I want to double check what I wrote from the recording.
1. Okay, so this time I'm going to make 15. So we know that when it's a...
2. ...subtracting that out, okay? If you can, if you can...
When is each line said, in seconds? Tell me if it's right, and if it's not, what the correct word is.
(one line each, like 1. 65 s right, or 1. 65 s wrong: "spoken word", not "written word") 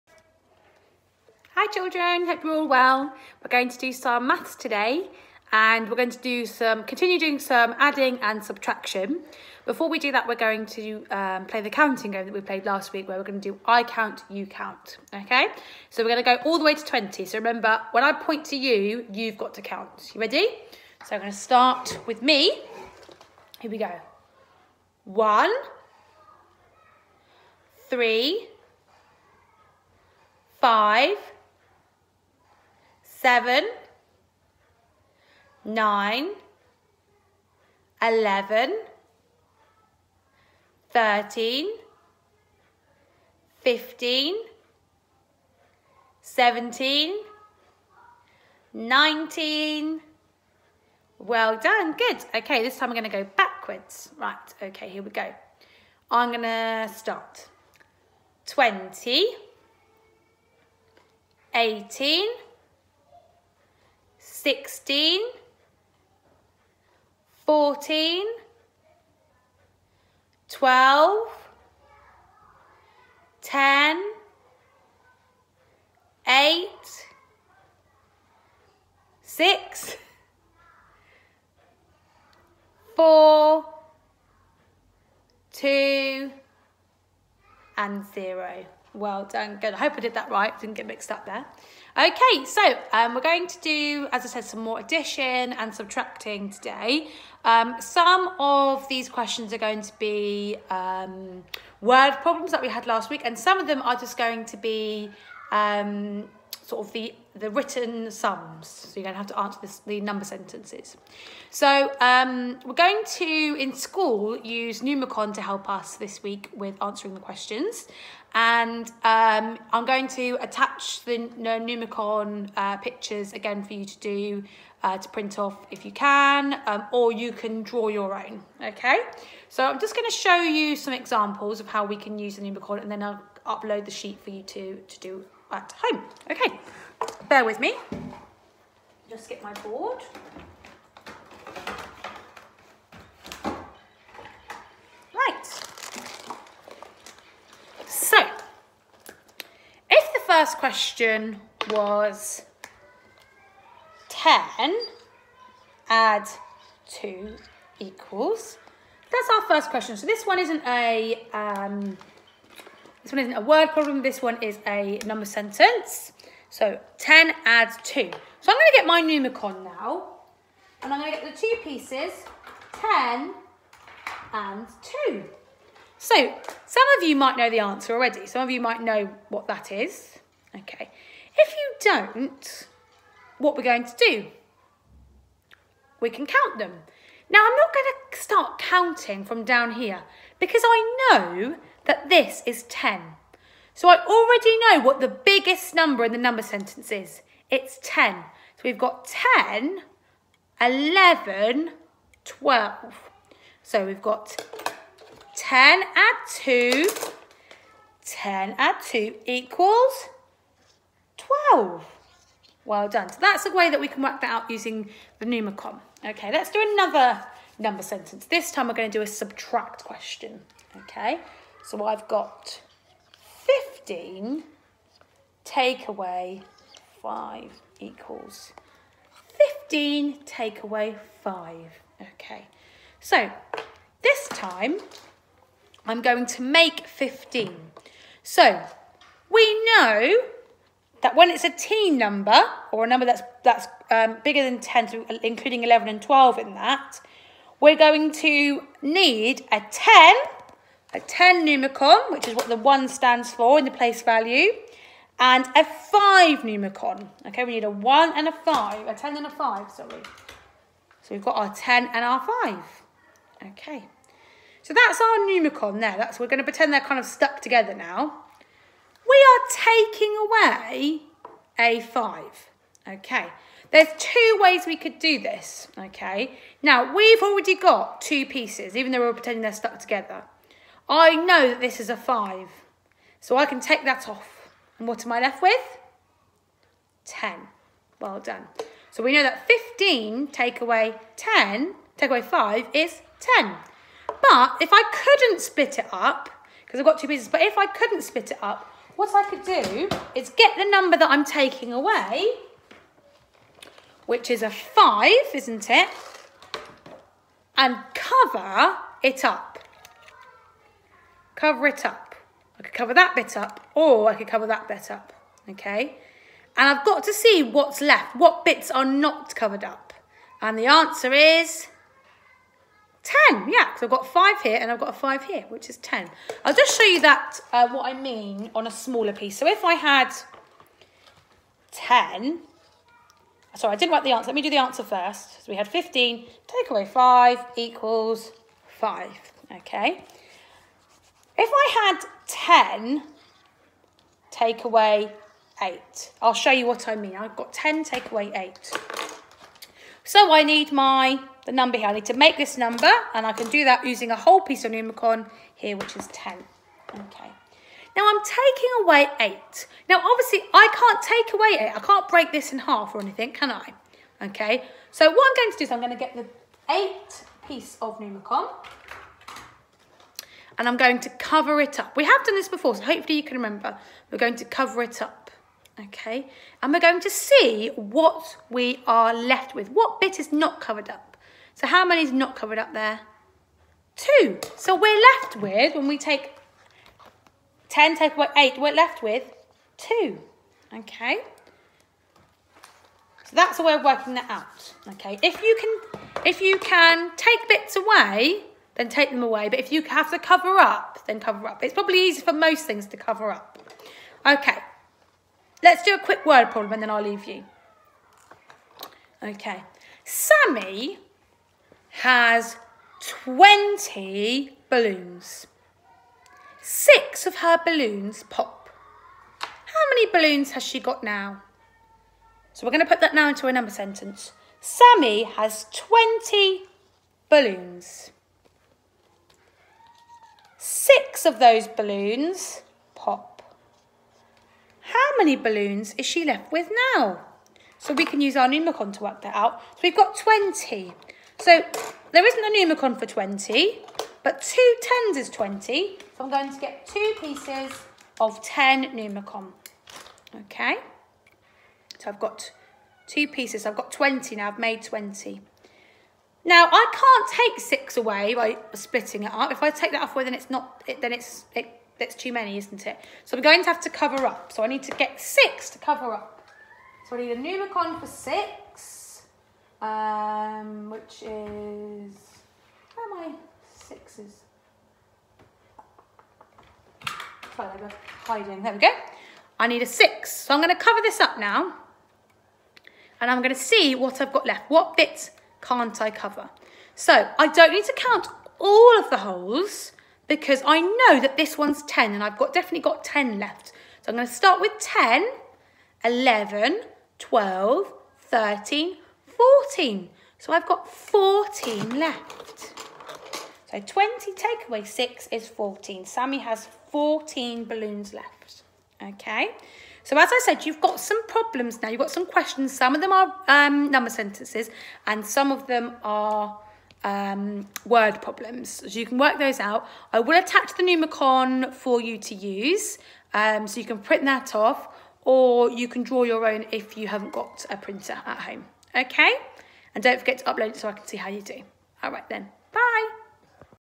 1. 232 s right
2. 393 s wrong: "working", not "subtracting".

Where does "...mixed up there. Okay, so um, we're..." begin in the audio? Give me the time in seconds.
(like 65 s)
90 s.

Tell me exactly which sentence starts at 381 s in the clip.
So how many is not covered up there?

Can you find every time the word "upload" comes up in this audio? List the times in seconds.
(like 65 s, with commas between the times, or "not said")
133 s, 530 s.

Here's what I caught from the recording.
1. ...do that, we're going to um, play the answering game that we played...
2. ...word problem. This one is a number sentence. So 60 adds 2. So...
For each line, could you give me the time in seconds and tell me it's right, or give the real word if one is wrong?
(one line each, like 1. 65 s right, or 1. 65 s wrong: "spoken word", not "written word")
1. 9 s wrong: "counting", not "answering"
2. 163 s wrong: "10", not "60".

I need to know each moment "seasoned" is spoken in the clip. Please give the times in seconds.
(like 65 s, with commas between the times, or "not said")
not said.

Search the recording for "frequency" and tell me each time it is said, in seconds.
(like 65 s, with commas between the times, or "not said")
not said.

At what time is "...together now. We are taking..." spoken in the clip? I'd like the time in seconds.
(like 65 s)
267 s.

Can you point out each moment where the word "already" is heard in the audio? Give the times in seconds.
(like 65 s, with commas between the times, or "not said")
177 s, 194 s, 277 s.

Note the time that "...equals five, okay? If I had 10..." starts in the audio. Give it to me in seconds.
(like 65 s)
337 s.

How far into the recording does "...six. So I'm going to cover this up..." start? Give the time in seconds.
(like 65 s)
479 s.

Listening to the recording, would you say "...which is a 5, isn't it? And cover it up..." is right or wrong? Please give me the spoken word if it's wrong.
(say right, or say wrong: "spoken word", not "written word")
right.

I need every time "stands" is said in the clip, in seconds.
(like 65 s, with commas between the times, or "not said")
252 s.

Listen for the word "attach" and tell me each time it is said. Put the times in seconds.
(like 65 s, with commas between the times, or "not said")
120 s, 520 s.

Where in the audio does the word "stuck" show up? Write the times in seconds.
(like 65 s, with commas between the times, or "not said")
267 s, 279 s.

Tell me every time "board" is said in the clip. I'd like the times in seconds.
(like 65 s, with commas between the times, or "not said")
139 s.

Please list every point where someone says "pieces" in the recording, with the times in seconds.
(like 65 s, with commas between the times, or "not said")
171 s, 278 s, 297 s, 329 s, 354 s, 367 s, 447 s, 453 s.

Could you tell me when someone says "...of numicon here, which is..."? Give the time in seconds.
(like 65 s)
354 s.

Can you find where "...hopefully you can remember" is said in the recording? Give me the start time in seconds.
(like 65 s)
372 s.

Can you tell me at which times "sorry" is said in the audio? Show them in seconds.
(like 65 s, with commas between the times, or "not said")
259 s, 333 s, 477 s.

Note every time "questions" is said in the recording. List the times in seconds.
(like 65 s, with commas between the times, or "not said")
99 s, 117 s, 150 s, 159 s, 219 s, 512 s.